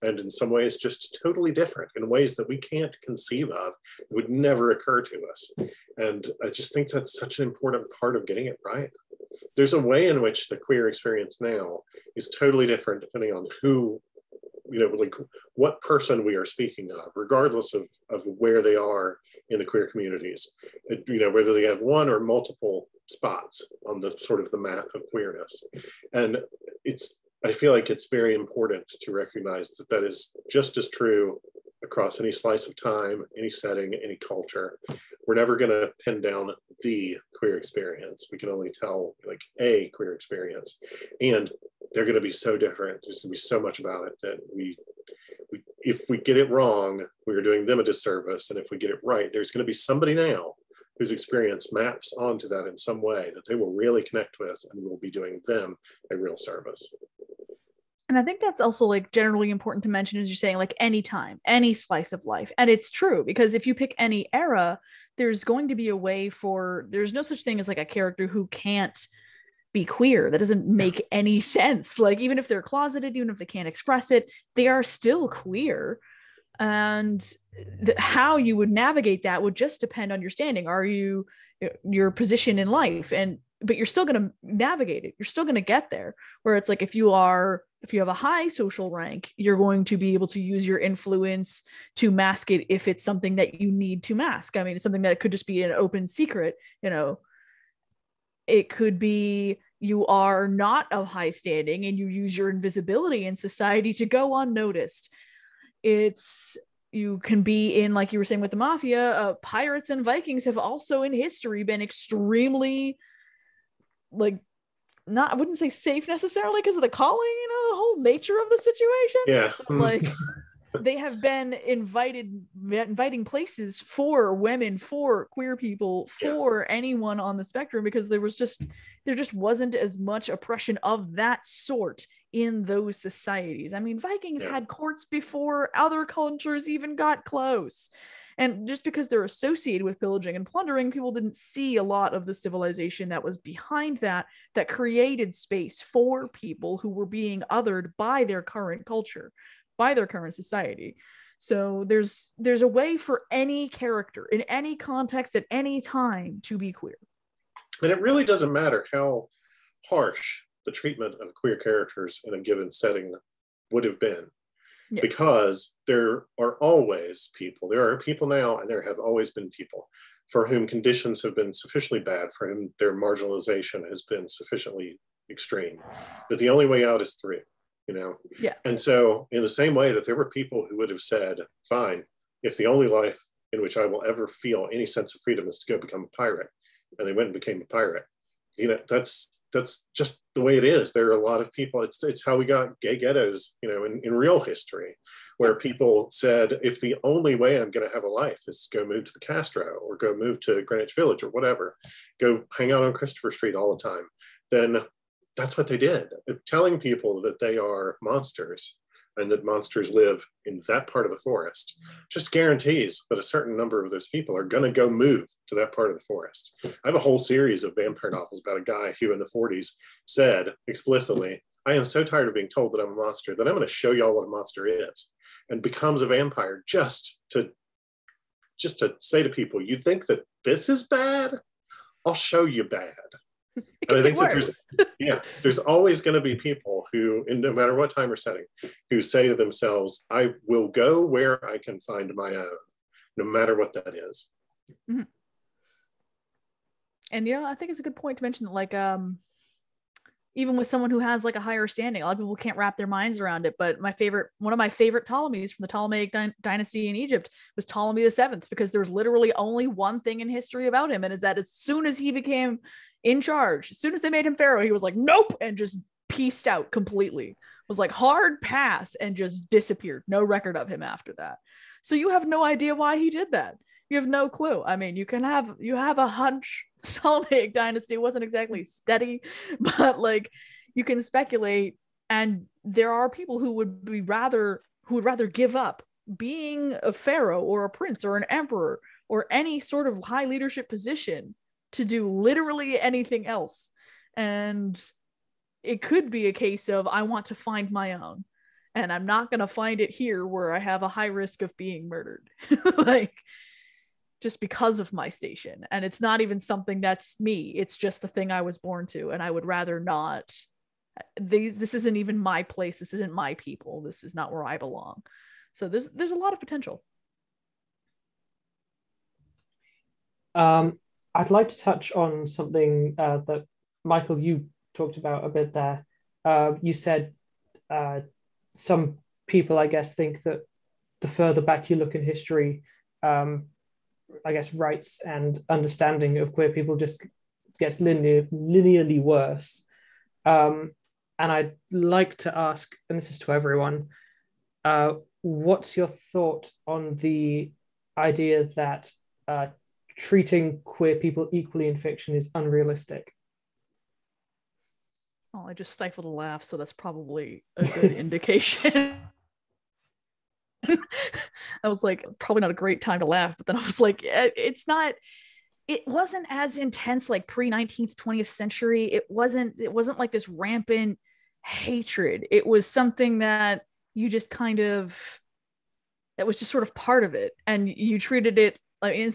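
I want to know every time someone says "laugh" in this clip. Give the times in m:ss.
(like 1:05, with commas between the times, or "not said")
5:56, 6:03.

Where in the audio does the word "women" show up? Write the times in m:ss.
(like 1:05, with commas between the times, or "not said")
2:04.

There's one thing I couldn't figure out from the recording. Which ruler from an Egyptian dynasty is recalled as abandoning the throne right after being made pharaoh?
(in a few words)
Ptolemy the Seventh.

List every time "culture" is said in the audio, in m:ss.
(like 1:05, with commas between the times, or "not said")
0:34, 2:16, 2:28.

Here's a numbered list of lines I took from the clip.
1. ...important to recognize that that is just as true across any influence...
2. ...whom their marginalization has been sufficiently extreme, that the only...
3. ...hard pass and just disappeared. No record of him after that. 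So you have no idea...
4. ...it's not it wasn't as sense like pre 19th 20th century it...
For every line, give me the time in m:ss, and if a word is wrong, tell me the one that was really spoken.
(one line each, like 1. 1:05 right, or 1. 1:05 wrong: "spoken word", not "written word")
1. 0:28 wrong: "slice", not "influence"
2. 2:52 right
3. 4:27 right
4. 6:04 wrong: "intense", not "sense".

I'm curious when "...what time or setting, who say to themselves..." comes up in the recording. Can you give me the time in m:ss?
3:57.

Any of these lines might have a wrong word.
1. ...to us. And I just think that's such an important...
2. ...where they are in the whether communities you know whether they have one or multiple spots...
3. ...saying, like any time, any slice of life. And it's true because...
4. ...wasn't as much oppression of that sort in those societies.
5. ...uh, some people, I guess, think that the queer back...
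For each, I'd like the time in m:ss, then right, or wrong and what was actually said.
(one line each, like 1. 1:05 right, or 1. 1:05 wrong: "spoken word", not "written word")
1. 0:05 right
2. 0:18 wrong: "queer", not "whether"
3. 1:00 right
4. 2:09 right
5. 5:27 wrong: "further", not "queer".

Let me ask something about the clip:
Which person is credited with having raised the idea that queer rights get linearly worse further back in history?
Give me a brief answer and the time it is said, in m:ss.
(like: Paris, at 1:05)
Michael, at 5:23.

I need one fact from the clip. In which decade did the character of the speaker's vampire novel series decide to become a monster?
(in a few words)
the 40s.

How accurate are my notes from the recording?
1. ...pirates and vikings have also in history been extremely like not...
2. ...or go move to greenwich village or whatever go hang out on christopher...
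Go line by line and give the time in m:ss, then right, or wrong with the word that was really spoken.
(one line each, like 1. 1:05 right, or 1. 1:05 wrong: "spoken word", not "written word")
1. 1:49 right
2. 3:19 right.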